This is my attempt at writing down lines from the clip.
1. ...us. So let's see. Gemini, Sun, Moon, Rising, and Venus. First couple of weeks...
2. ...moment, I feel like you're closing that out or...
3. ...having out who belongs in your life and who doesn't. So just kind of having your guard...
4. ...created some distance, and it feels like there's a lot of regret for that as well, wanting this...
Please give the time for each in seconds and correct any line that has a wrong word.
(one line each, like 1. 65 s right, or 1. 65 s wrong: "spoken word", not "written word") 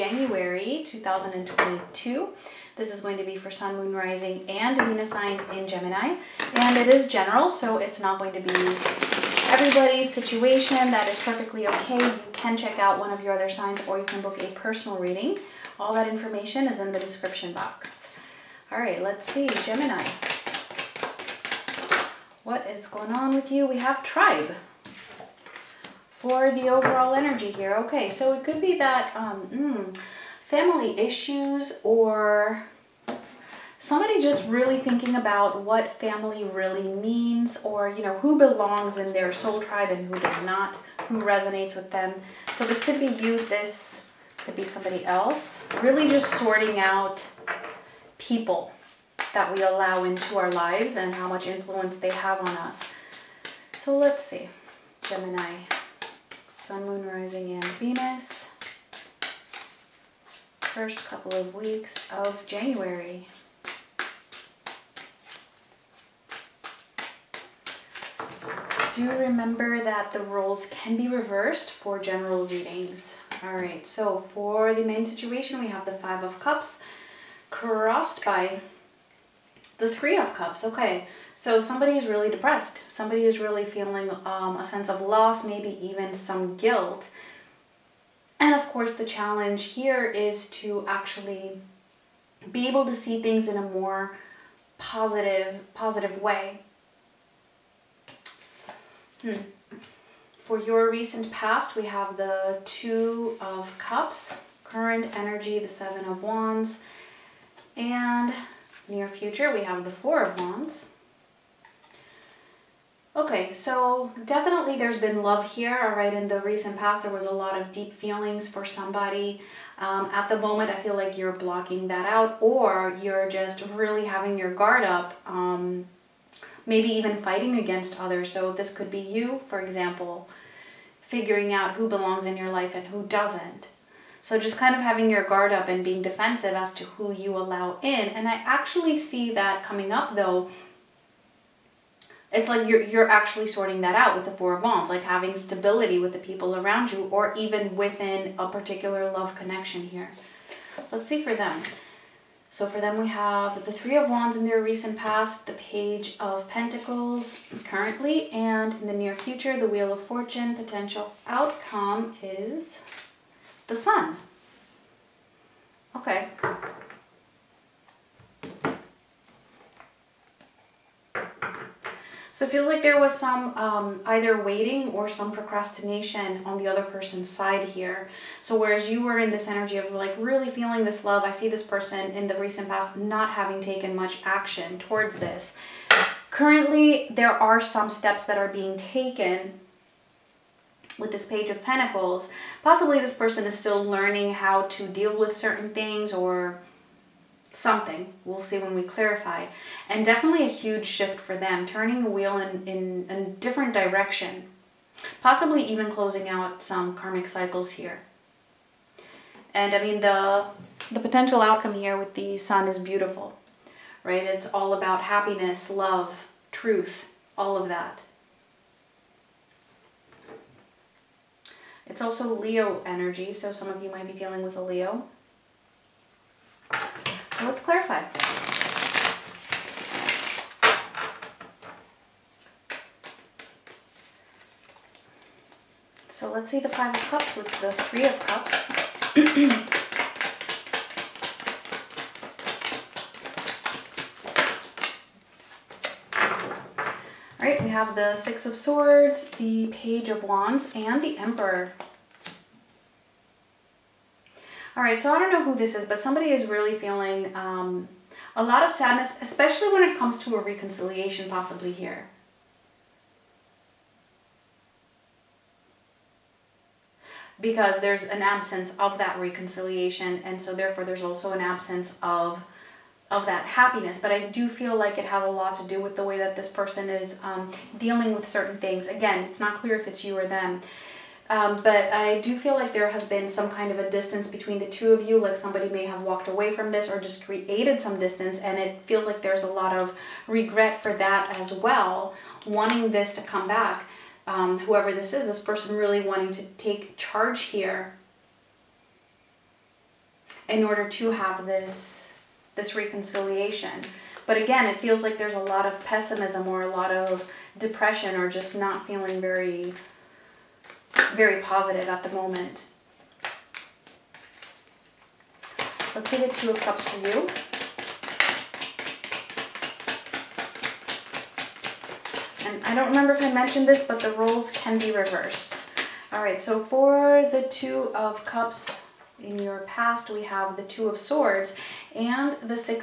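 1. 52 s right
2. 120 s wrong: "blocking", not "closing"
3. 130 s wrong: "figuring", not "having"
4. 287 s right.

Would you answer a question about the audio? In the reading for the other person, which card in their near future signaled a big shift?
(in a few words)
Wheel of Fortune.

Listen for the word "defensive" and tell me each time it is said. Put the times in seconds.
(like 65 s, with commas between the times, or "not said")
135 s.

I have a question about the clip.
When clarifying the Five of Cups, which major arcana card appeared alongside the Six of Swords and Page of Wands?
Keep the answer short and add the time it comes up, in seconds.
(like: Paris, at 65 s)
The Emperor, at 251 s.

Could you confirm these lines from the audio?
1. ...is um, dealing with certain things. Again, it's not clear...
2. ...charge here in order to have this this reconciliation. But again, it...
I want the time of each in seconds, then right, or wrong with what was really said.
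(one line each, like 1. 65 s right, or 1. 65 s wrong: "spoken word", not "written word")
1. 276 s right
2. 296 s right.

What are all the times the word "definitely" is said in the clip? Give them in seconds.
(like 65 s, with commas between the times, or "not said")
114 s, 200 s.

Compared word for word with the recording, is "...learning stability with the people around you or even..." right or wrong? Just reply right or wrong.
wrong.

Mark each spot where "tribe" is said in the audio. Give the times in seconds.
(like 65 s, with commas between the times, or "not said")
24 s, 39 s.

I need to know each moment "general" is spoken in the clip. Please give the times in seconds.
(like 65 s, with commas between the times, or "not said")
7 s, 71 s.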